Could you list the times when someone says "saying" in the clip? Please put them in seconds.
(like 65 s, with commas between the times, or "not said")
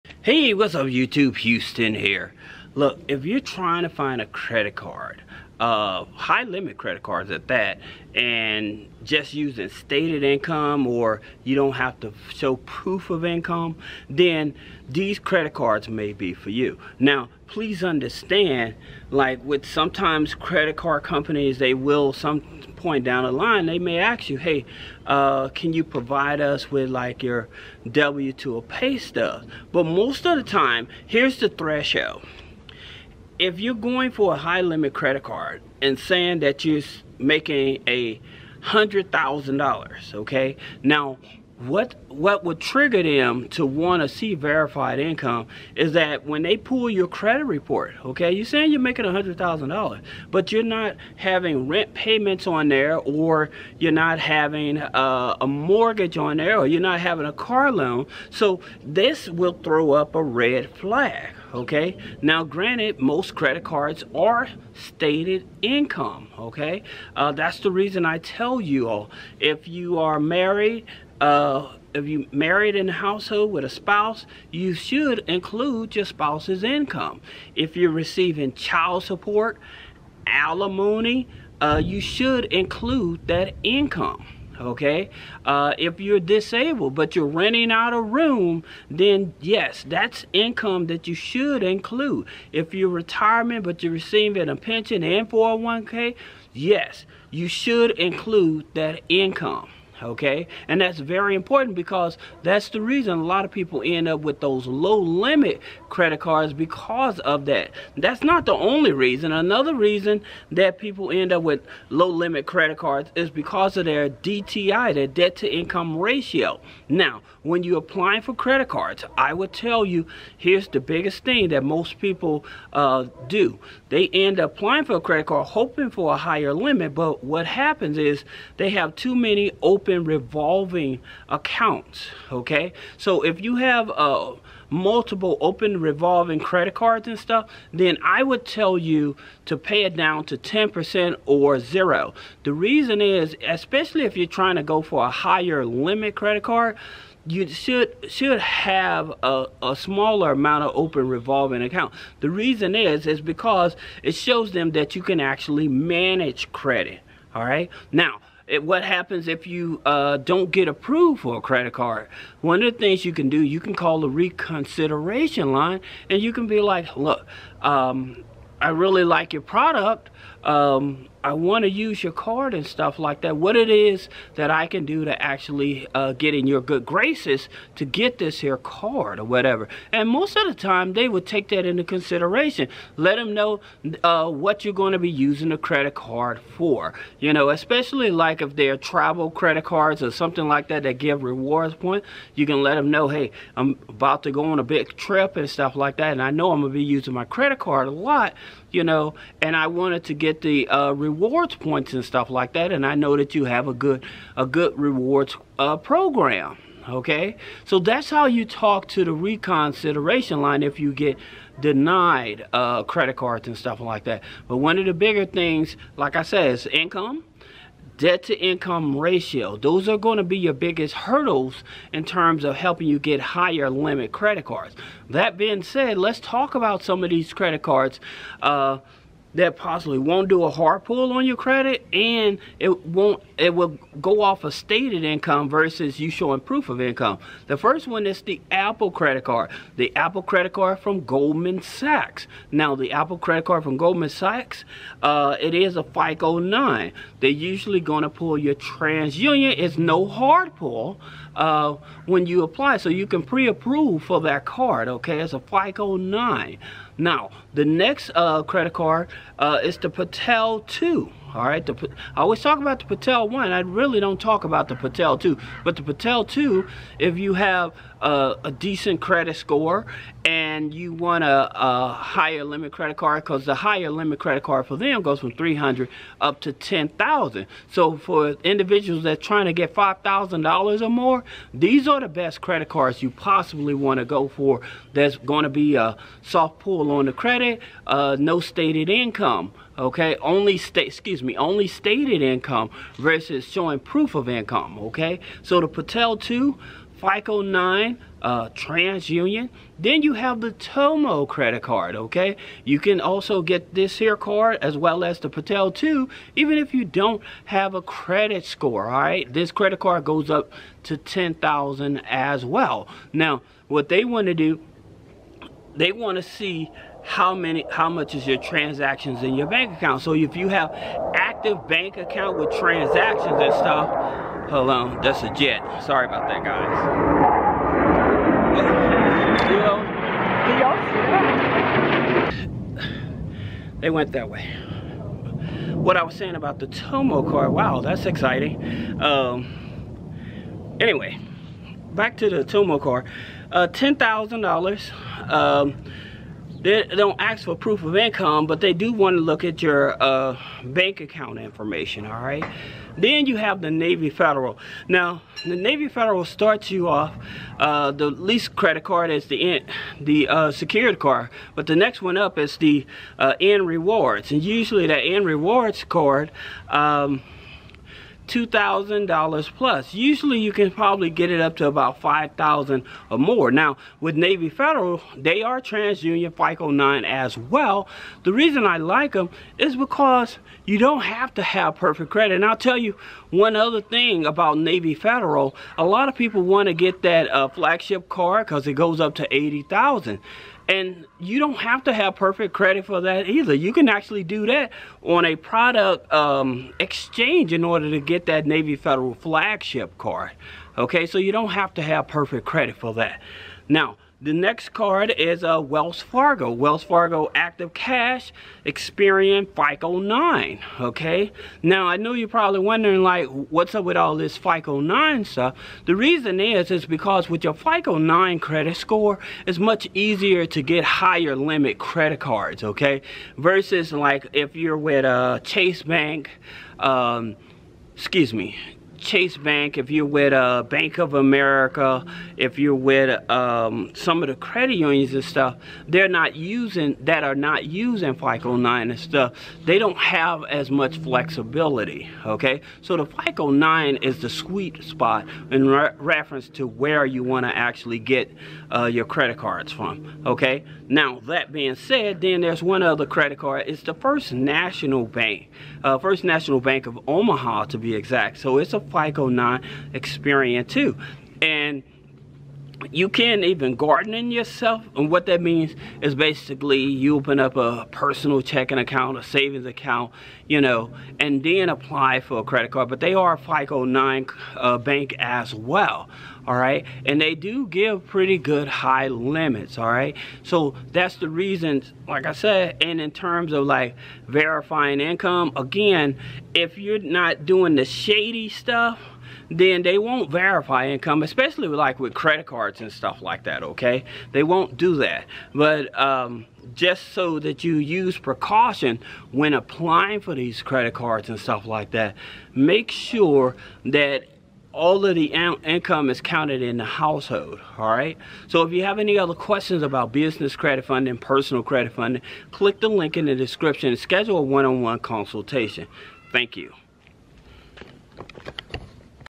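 35 s, 48 s, 336 s.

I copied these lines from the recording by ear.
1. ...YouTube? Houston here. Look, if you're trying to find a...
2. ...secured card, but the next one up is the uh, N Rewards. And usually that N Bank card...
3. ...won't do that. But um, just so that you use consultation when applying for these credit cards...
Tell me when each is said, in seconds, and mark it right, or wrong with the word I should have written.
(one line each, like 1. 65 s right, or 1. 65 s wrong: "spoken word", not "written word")
1. 0 s right
2. 360 s wrong: "Rewards", not "Bank"
3. 494 s wrong: "precaution", not "consultation".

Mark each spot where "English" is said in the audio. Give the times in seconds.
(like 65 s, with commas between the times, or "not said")
not said.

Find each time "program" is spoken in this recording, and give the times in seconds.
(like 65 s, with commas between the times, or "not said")
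205 s.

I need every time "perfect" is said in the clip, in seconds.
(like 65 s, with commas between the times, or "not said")
381 s, 392 s, 402 s.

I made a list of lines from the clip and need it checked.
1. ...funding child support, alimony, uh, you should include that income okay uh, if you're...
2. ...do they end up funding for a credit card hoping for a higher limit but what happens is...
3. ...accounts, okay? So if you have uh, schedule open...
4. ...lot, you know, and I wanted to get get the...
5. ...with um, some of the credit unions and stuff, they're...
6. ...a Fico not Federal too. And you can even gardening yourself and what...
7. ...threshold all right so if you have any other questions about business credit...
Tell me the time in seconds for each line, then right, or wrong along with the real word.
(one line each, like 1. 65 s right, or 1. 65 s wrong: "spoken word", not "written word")
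1. 77 s wrong: "receiving", not "funding"
2. 123 s wrong: "applying", not "funding"
3. 131 s wrong: "multiple", not "schedule"
4. 197 s right
5. 432 s right
6. 458 s wrong: "Experian", not "Federal"
7. 506 s wrong: "household", not "threshold".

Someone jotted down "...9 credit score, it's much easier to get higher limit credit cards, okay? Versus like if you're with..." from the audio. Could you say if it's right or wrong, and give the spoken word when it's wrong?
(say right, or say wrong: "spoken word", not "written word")
right.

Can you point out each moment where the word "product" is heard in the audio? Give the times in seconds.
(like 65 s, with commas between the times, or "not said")
169 s, 395 s.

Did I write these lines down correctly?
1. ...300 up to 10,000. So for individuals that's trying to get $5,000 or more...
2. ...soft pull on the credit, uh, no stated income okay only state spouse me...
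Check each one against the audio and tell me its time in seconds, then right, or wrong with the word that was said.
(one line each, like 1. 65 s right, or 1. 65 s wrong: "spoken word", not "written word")
1. 275 s right
2. 286 s wrong: "excuse", not "spouse".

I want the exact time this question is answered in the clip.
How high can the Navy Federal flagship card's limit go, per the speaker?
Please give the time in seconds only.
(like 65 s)
389 s.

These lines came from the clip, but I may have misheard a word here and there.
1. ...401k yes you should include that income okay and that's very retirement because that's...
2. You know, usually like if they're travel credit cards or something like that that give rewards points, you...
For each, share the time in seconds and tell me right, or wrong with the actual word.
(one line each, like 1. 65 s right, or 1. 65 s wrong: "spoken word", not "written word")
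1. 95 s wrong: "important", not "retirement"
2. 187 s wrong: "especially", not "usually".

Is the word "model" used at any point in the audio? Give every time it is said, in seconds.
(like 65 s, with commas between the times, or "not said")
not said.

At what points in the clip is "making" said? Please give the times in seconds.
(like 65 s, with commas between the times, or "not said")
37 s, 48 s.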